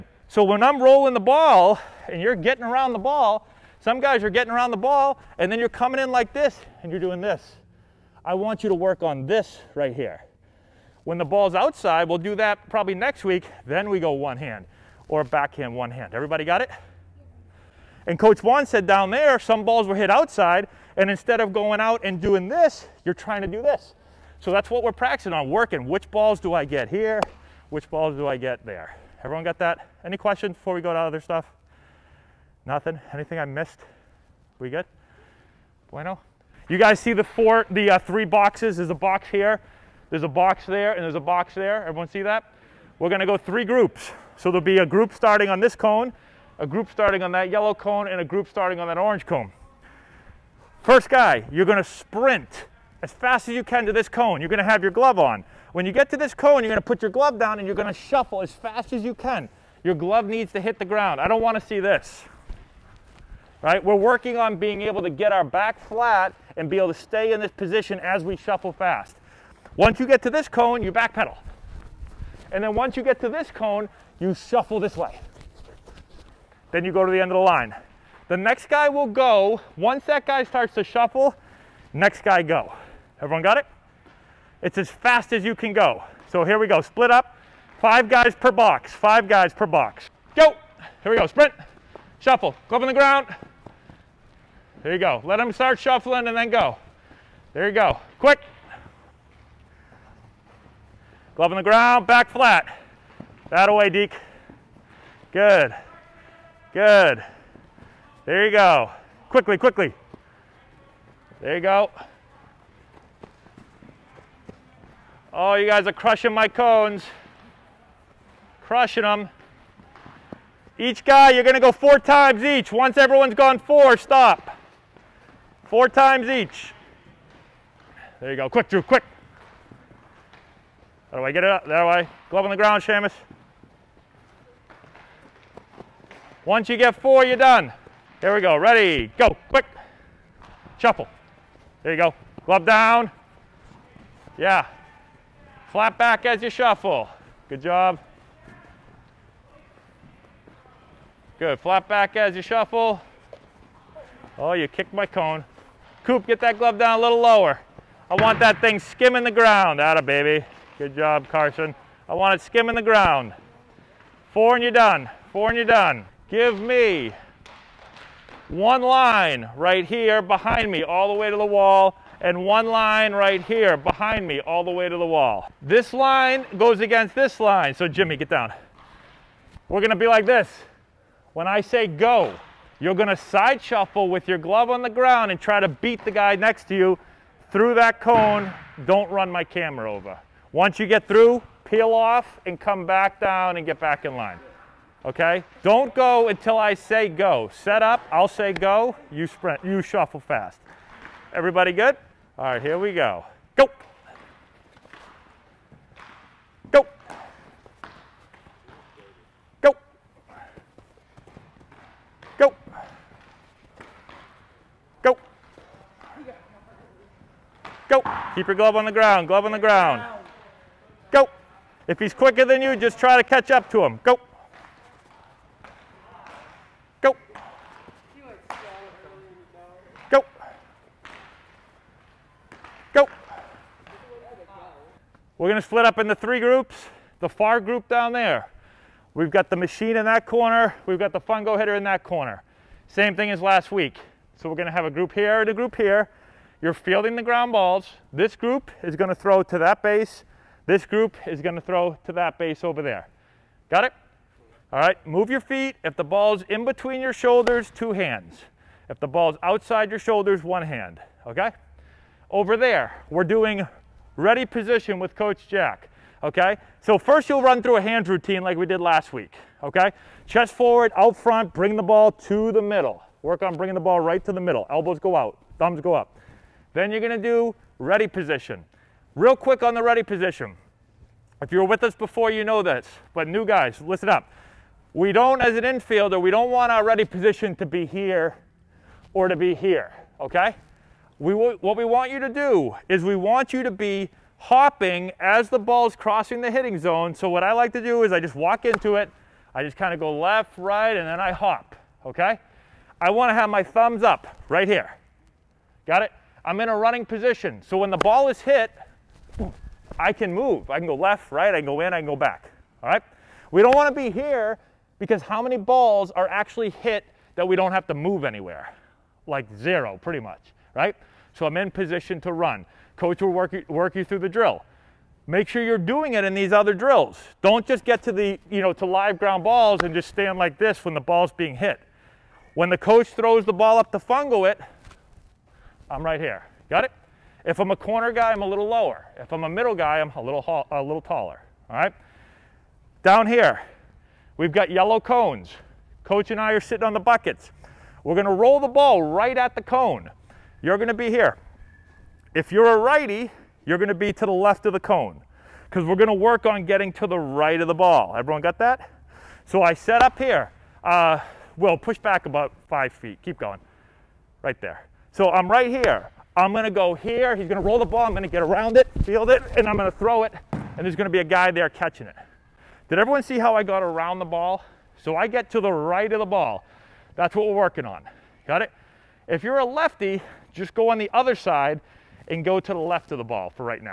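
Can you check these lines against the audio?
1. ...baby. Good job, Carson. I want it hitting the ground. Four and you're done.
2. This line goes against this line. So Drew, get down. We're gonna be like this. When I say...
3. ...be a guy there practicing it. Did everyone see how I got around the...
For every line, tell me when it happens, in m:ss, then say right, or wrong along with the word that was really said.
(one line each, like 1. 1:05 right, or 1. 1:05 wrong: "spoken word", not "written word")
1. 2:40 wrong: "skimming", not "hitting"
2. 2:55 wrong: "Jimmy", not "Drew"
3. 6:11 wrong: "catching", not "practicing".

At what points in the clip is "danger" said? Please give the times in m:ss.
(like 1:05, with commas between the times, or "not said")
not said.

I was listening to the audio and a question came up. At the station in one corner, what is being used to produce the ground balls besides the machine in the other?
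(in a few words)
fungo hitter.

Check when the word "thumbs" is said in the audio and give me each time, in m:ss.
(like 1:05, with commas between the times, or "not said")
4:35, 5:03.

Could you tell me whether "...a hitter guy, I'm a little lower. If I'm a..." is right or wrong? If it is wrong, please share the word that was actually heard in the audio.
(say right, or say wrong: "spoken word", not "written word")
wrong: "corner", not "hitter".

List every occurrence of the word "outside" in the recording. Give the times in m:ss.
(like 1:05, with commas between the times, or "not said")
0:11, 0:20, 4:19.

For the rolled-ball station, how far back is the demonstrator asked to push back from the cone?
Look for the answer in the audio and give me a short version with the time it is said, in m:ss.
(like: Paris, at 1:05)
5 feet, at 6:02.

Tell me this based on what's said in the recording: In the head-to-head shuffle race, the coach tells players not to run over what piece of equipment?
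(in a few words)
camera.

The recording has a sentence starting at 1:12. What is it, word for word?
And then once you get to this cone, you shuffle this way.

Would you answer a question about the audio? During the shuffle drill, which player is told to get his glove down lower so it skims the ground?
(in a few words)
Coop.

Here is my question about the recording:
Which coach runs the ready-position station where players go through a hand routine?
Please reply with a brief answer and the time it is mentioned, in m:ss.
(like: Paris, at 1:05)
Coach Jack, at 4:25.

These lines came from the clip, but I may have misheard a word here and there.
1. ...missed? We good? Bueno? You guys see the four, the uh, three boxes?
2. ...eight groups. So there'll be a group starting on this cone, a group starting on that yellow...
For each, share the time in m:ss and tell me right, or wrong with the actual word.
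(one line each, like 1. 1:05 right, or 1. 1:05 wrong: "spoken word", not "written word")
1. 0:33 right
2. 0:43 wrong: "three", not "eight".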